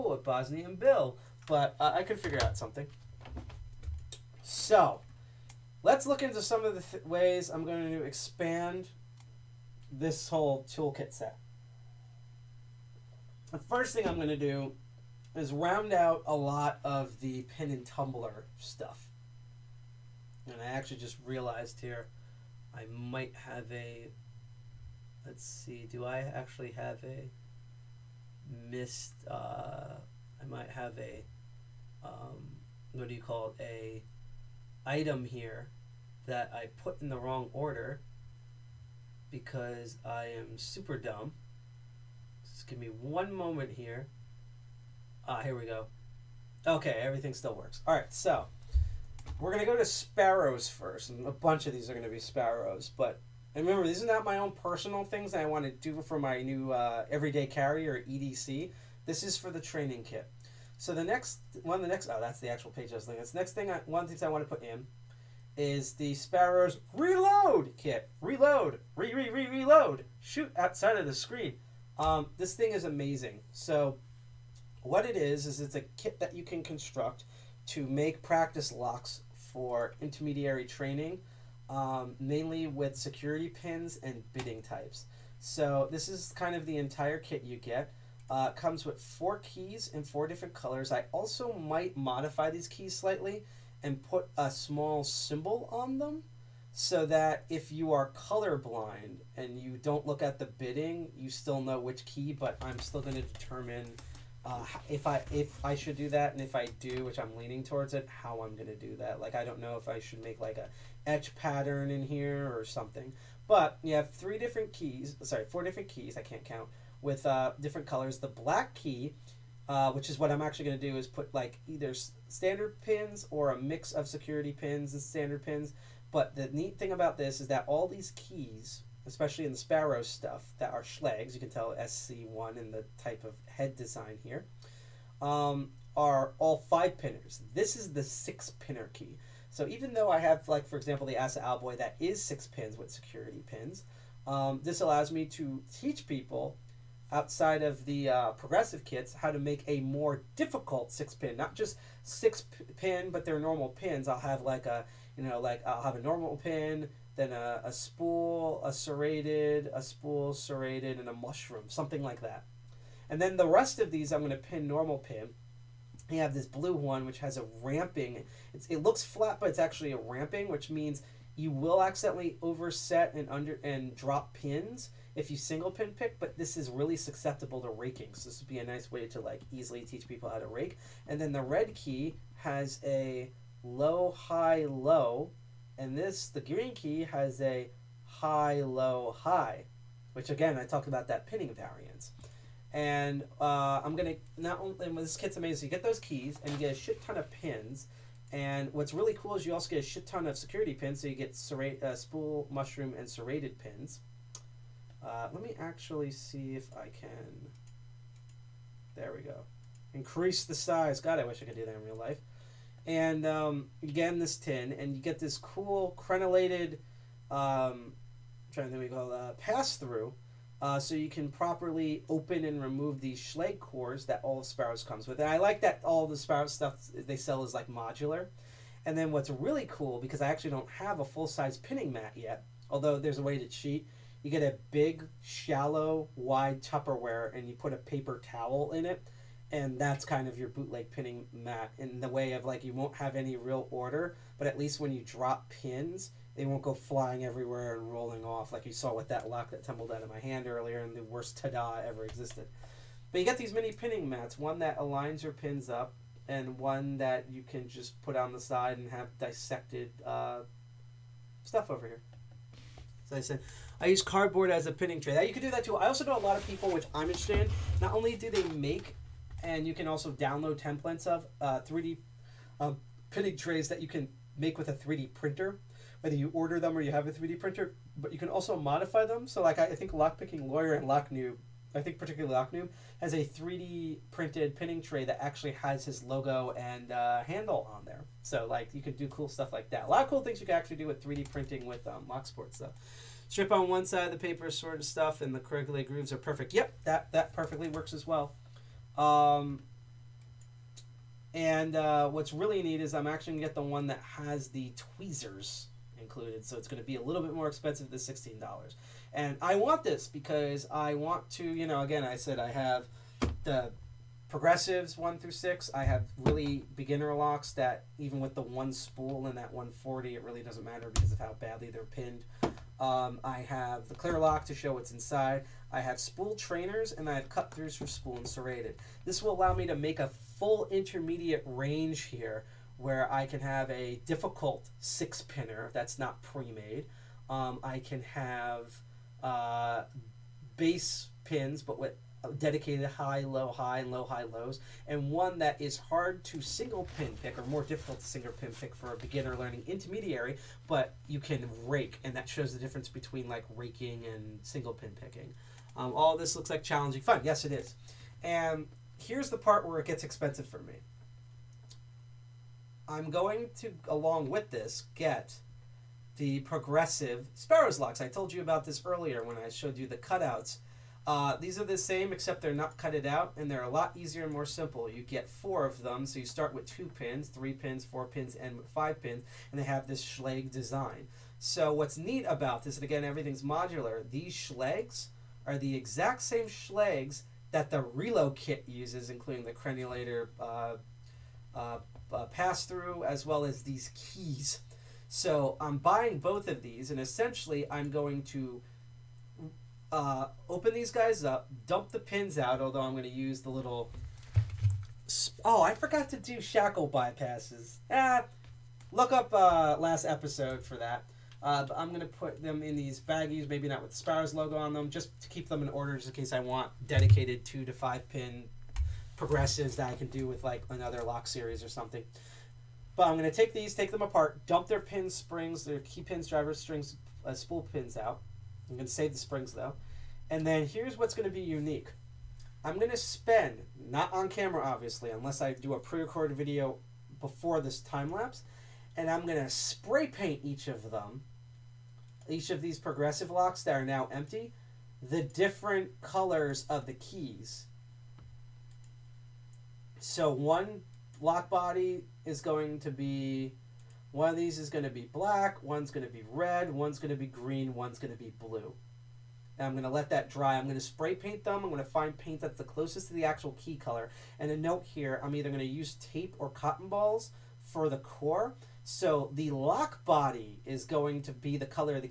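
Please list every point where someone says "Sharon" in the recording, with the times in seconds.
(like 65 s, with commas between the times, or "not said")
not said.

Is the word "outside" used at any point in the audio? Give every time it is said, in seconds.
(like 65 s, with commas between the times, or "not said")
70 s, 147 s.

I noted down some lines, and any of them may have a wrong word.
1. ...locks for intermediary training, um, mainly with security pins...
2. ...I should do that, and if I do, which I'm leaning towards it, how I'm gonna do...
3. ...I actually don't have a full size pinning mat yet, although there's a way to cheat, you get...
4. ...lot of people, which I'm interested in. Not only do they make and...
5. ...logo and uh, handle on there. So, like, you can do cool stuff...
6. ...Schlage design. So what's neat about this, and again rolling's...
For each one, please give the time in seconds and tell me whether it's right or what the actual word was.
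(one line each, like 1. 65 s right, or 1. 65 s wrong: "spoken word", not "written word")
1. 78 s right
2. 105 s right
3. 230 s right
4. 266 s right
5. 286 s right
6. 380 s wrong: "everything", not "rolling".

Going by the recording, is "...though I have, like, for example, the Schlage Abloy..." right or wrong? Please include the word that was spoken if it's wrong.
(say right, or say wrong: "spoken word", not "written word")
wrong: "ASSA", not "Schlage".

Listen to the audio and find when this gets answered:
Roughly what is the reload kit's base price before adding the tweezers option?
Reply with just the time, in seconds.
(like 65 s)
307 s.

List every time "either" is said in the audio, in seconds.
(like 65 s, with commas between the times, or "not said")
121 s, 465 s.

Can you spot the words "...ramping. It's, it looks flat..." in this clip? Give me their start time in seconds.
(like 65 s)
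167 s.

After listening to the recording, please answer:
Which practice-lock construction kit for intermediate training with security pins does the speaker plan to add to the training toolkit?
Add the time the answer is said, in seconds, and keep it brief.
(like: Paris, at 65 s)
Sparrows Reload kit, at 66 s.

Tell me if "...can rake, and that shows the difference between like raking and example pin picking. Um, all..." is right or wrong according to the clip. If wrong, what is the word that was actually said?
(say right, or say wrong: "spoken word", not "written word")
wrong: "single", not "example".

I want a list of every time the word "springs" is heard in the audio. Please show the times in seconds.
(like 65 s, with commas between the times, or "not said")
425 s, 429 s.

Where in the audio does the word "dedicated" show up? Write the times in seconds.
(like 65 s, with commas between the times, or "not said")
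342 s, 416 s.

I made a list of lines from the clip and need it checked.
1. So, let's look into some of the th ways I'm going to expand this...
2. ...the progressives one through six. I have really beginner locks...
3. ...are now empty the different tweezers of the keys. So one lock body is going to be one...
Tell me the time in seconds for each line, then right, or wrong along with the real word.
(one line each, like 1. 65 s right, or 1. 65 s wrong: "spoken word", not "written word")
1. 4 s right
2. 313 s right
3. 443 s wrong: "colors", not "tweezers".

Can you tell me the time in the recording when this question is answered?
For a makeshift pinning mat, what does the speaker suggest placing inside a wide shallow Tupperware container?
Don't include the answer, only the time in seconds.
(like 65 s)
237 s.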